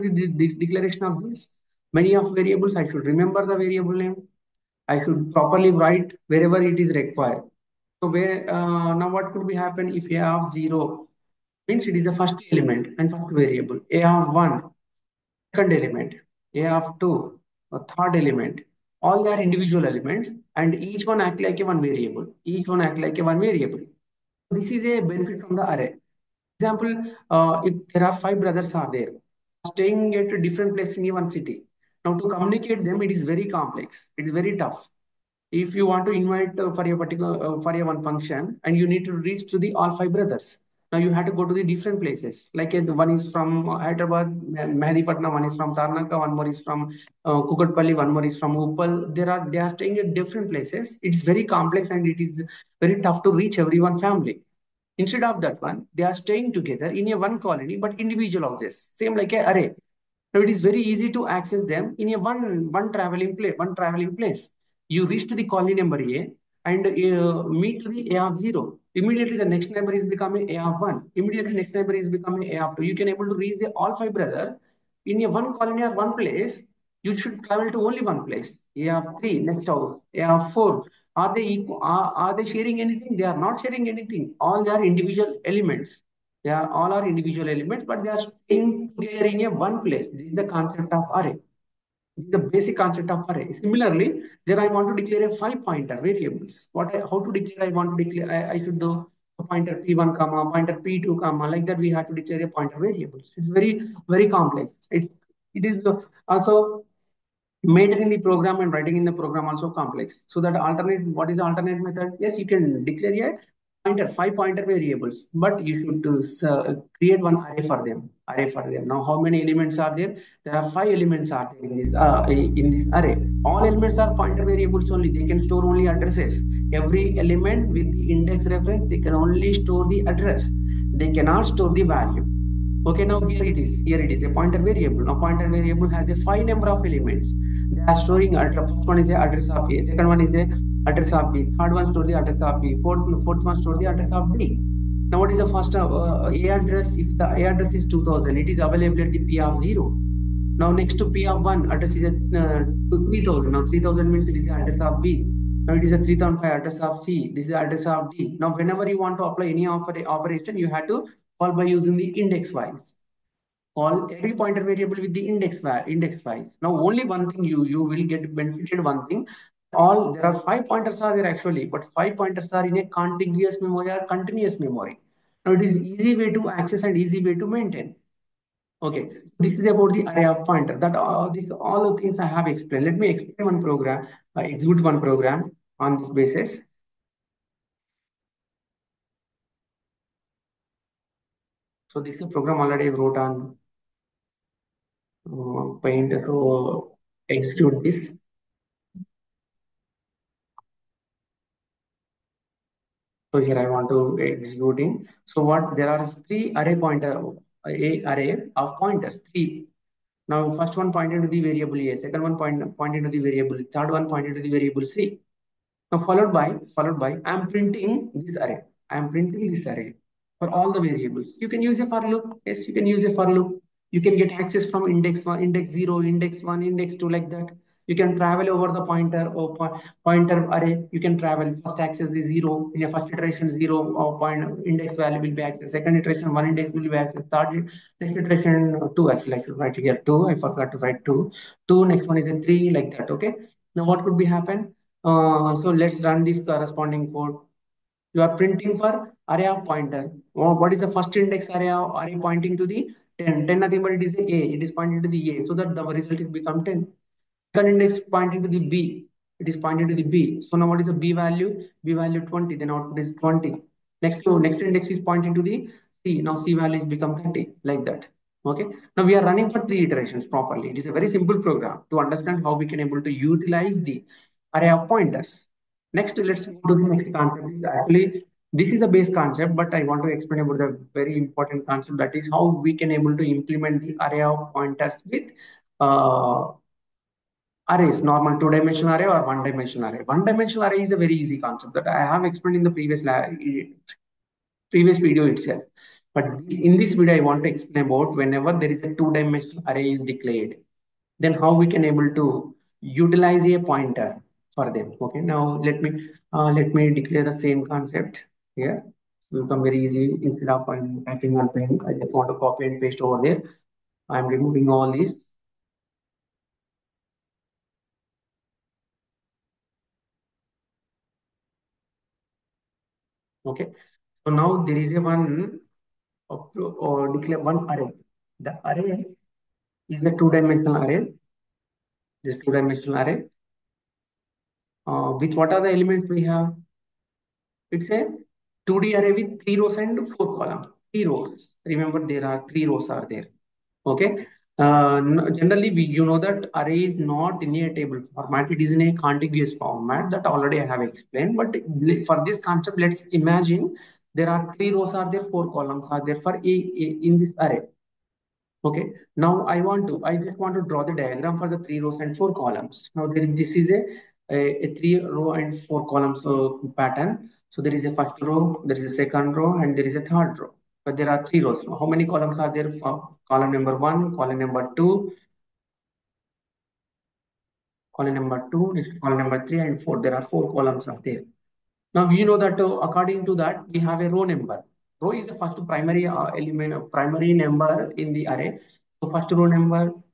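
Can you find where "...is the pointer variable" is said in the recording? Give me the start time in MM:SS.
02:14.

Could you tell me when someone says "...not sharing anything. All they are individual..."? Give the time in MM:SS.
01:23.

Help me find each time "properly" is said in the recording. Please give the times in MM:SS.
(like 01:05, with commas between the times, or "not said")
00:05, 04:30.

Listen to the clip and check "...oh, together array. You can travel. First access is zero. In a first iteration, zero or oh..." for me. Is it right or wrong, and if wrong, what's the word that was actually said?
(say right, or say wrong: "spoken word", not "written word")
wrong: "pointer", not "together".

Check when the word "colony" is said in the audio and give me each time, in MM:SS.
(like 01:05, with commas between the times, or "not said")
00:57, 01:05, 01:15.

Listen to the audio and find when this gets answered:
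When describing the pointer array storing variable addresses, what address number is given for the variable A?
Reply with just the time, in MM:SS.
02:27.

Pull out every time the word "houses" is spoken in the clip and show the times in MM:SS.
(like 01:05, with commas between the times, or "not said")
00:58, 01:19.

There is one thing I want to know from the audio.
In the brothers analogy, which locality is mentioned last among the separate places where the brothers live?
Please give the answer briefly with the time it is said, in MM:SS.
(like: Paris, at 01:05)
Uppal, at 00:48.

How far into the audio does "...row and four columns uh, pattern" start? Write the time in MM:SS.
06:05.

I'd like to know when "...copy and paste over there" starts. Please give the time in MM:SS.
05:12.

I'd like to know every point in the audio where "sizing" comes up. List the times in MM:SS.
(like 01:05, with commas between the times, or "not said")
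not said.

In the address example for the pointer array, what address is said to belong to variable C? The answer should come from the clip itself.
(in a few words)
3005.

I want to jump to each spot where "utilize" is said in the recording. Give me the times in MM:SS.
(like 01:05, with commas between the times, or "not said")
04:33, 05:02.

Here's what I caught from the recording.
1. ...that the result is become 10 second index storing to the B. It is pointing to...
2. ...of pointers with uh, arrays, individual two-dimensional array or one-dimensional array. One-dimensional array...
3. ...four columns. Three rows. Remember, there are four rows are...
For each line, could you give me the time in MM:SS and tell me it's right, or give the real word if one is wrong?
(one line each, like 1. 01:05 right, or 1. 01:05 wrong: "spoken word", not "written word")
1. 04:15 wrong: "pointing", not "storing"
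2. 04:44 wrong: "normal", not "individual"
3. 05:40 wrong: "three", not "four".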